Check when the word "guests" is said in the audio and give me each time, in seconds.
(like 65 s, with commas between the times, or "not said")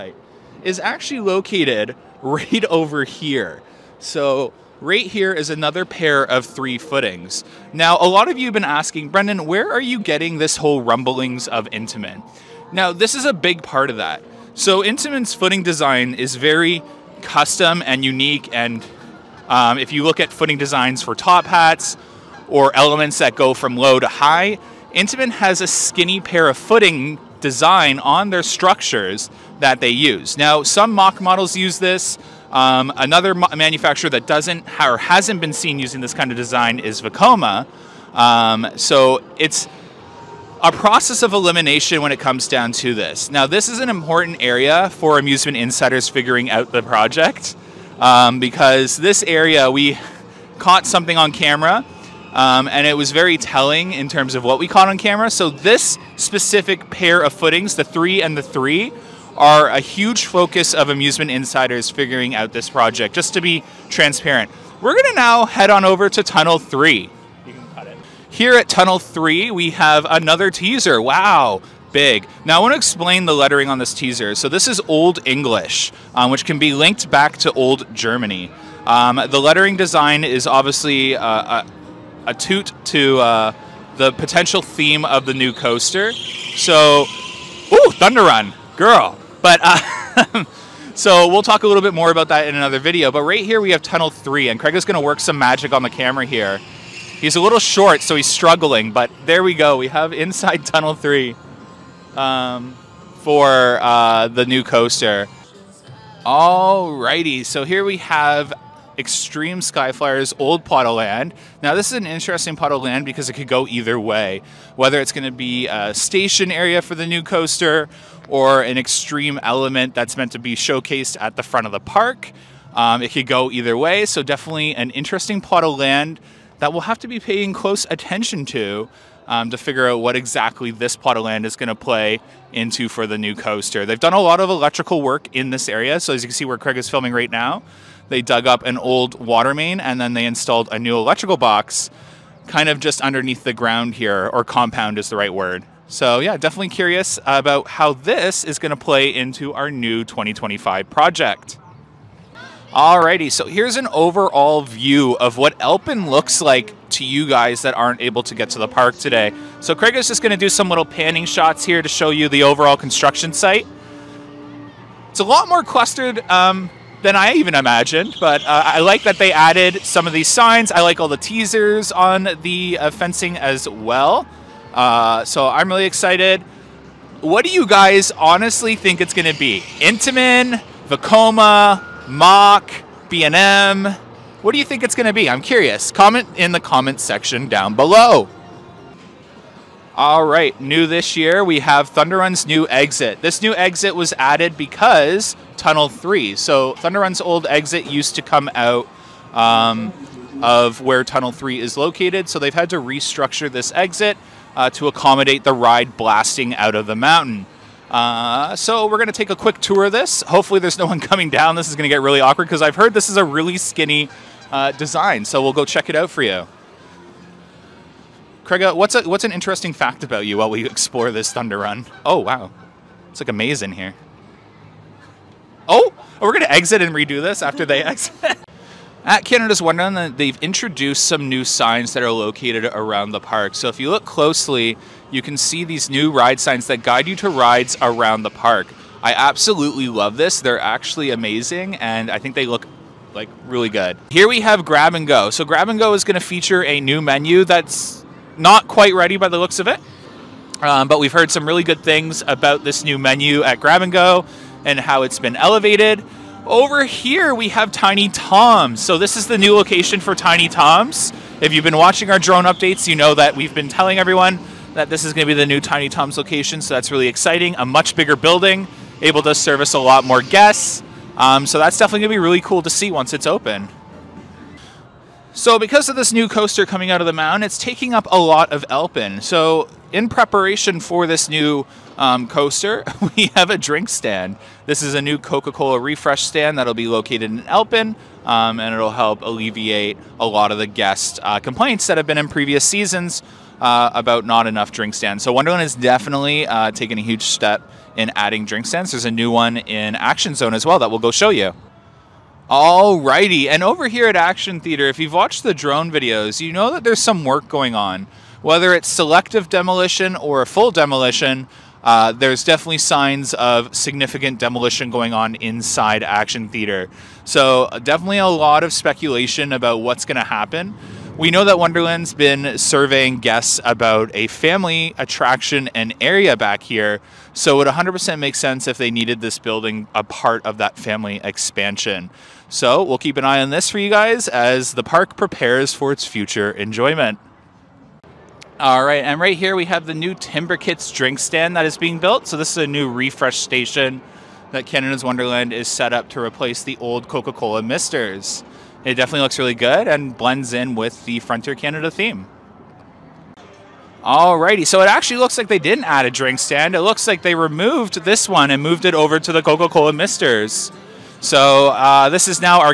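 270 s, 290 s, 323 s.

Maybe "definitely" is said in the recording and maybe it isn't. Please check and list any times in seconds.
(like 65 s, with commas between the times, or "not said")
124 s, 146 s, 271 s, 295 s, 312 s, 317 s, 348 s.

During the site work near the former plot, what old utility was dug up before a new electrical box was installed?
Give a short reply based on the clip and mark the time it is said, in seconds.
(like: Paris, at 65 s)
water main, at 139 s.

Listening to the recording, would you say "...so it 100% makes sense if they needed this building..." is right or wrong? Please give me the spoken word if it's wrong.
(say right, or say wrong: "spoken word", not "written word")
right.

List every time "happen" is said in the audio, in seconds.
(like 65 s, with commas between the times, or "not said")
320 s.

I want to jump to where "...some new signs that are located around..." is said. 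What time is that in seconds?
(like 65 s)
231 s.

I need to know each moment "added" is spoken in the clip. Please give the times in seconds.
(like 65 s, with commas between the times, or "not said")
169 s, 194 s.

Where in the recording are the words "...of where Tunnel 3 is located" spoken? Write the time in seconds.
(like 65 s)
200 s.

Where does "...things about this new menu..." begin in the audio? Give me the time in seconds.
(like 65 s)
251 s.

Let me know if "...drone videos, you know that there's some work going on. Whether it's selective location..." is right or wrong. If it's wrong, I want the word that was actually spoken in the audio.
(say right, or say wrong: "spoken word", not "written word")
wrong: "demolition", not "location".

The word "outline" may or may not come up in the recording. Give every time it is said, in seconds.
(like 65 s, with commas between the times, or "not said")
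not said.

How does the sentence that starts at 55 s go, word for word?
So this specific pair of footings, the three and the three, are a huge focus of amusement insiders figuring out this project.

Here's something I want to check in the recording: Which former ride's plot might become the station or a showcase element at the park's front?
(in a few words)
Extreme Skyflyer.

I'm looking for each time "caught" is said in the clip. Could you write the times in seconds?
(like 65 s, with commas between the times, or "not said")
50 s, 54 s.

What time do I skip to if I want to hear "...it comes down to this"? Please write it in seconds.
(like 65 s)
42 s.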